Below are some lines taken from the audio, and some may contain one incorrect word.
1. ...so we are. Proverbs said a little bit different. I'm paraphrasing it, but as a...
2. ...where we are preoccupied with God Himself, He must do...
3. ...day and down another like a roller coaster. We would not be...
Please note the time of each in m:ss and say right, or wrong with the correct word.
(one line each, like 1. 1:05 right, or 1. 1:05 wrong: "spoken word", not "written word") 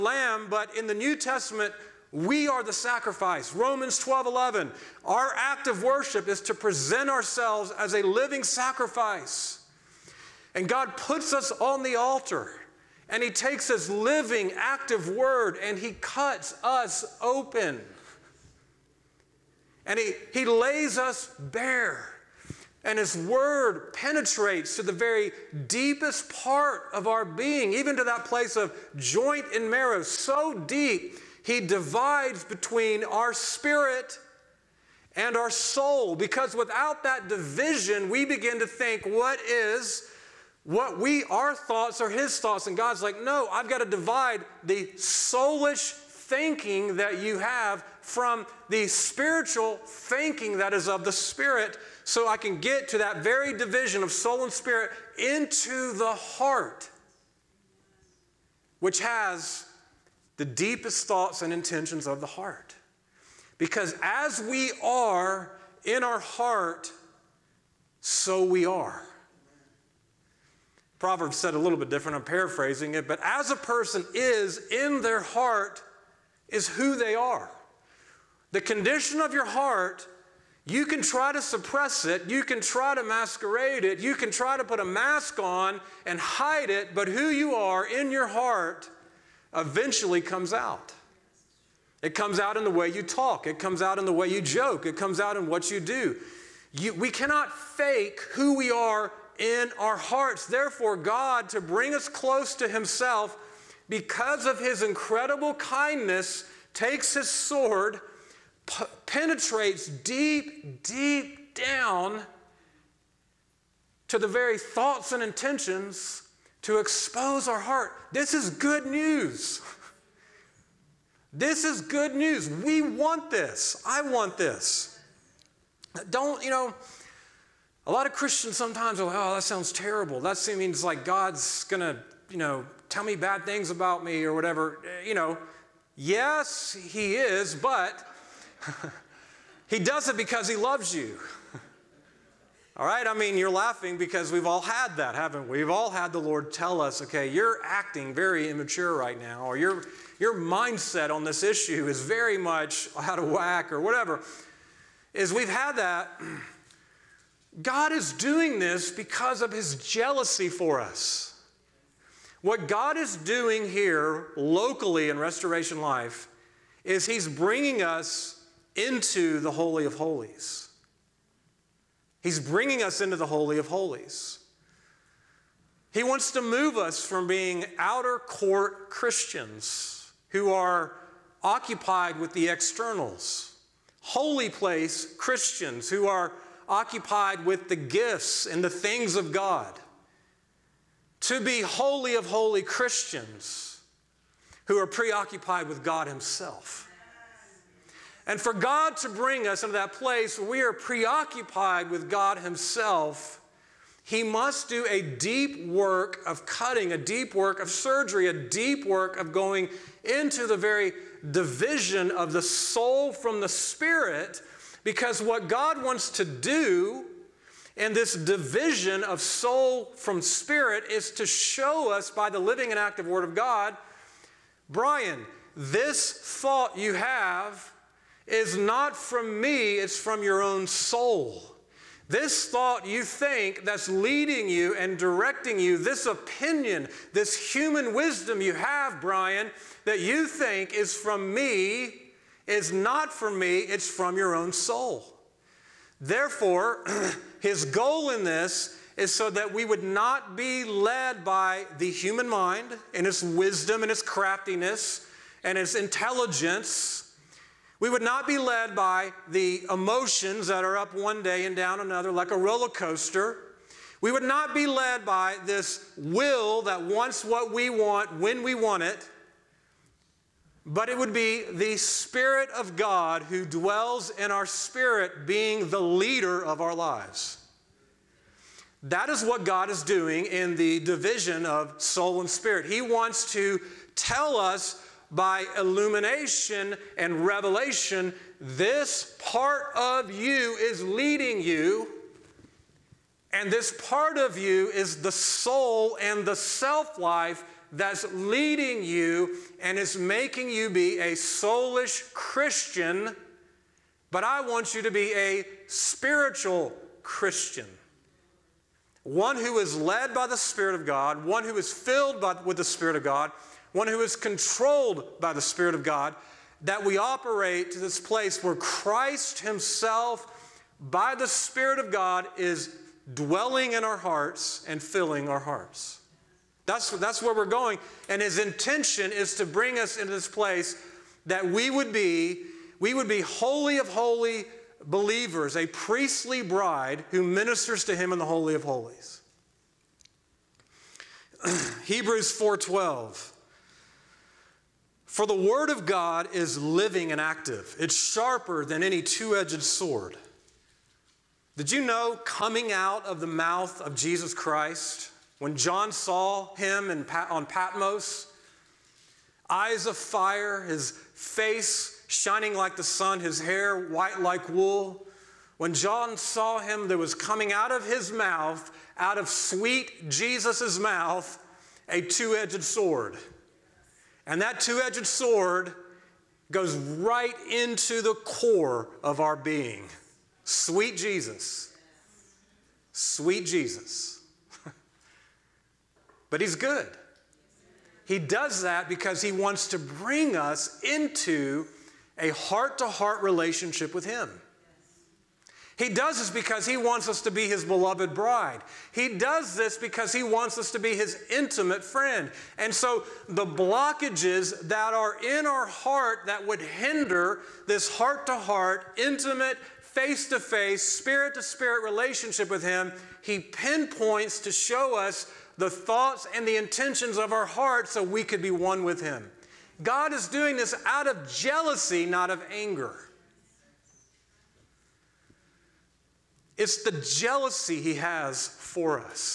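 1. 1:08 right
2. 3:20 right
3. 4:21 right.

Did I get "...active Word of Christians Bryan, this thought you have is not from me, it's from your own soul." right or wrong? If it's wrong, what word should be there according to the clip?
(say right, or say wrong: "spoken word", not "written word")
wrong: "God", not "Christians".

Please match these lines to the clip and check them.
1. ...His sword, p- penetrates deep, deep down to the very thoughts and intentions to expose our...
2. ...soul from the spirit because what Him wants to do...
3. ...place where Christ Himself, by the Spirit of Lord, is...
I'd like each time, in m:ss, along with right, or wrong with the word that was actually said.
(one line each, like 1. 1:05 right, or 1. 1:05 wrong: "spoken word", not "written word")
1. 1:47 right
2. 3:32 wrong: "God", not "Him"
3. 5:17 wrong: "God", not "Lord".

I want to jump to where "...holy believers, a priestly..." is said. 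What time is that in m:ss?
5:33.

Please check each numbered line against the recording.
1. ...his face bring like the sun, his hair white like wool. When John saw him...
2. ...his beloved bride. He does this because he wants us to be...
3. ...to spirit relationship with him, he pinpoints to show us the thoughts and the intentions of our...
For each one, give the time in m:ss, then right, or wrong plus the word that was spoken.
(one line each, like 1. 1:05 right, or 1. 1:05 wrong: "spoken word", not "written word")
1. 6:00 wrong: "shining", not "bring"
2. 6:37 right
3. 6:51 right.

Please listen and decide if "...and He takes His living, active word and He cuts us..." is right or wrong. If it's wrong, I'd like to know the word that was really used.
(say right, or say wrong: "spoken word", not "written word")
right.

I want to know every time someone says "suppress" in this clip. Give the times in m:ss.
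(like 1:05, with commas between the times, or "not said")
1:21.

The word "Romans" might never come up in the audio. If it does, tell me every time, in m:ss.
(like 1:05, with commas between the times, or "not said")
0:03.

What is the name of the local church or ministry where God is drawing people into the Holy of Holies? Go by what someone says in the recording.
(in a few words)
Restoration Life.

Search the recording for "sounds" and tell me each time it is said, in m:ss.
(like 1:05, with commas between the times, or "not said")
2:09.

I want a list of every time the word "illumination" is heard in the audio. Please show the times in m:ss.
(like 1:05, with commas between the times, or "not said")
4:45.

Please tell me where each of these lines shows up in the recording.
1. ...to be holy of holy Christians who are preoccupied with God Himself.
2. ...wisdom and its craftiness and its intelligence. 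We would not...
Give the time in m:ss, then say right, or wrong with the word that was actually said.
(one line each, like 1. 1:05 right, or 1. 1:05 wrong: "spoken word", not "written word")
1. 3:11 right
2. 4:13 right.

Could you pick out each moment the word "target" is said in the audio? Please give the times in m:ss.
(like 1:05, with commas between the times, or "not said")
not said.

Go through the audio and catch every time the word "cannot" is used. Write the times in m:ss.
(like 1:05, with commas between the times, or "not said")
1:37.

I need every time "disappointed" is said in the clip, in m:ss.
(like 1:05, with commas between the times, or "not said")
not said.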